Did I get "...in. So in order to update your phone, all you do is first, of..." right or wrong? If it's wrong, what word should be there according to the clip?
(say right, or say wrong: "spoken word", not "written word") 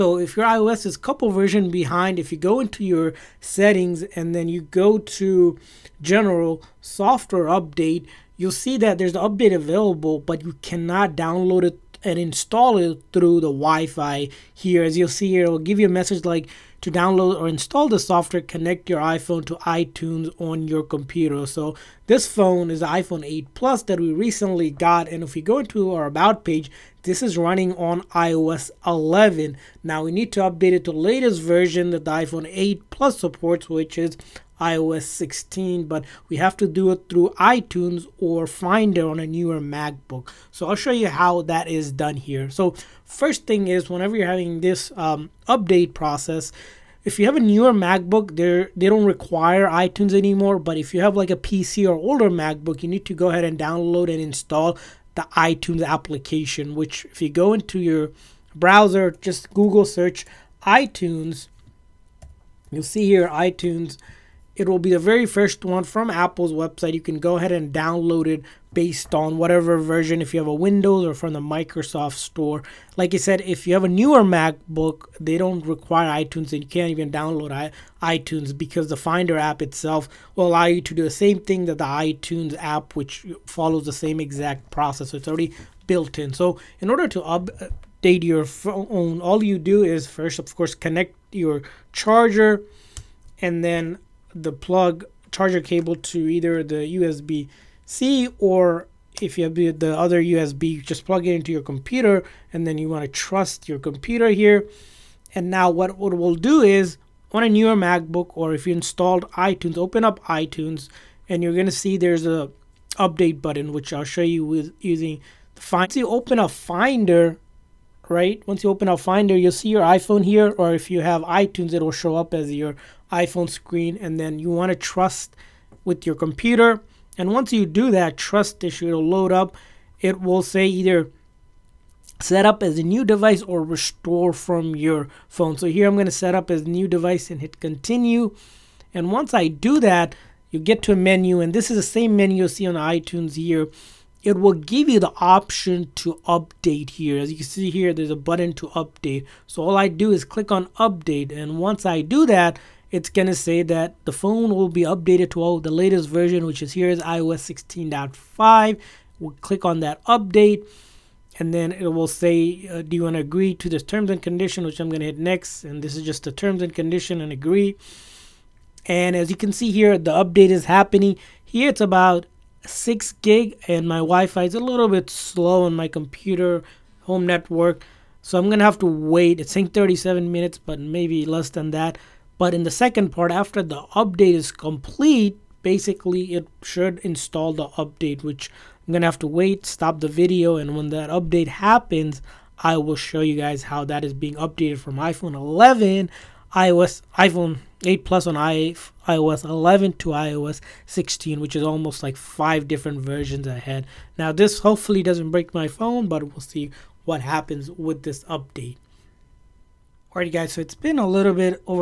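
right.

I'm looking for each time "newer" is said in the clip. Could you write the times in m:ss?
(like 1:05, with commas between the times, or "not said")
0:39, 0:47, 1:13, 1:47.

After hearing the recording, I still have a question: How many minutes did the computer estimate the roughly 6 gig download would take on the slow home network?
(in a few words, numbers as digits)
37.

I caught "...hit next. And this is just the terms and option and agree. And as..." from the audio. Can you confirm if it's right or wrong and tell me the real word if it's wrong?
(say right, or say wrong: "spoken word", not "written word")
wrong: "condition", not "option".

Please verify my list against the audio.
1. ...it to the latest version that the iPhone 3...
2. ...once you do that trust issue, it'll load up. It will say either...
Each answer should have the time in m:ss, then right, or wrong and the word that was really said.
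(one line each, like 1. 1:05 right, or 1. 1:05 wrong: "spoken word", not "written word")
1. 0:30 wrong: "8", not "3"
2. 2:07 right.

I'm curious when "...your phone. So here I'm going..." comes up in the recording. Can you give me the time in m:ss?
2:14.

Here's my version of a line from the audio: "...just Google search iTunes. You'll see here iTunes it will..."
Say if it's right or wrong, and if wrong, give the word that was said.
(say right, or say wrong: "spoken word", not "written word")
right.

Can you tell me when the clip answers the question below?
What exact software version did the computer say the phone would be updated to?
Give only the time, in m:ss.
2:37.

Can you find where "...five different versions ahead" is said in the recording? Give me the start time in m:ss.
3:22.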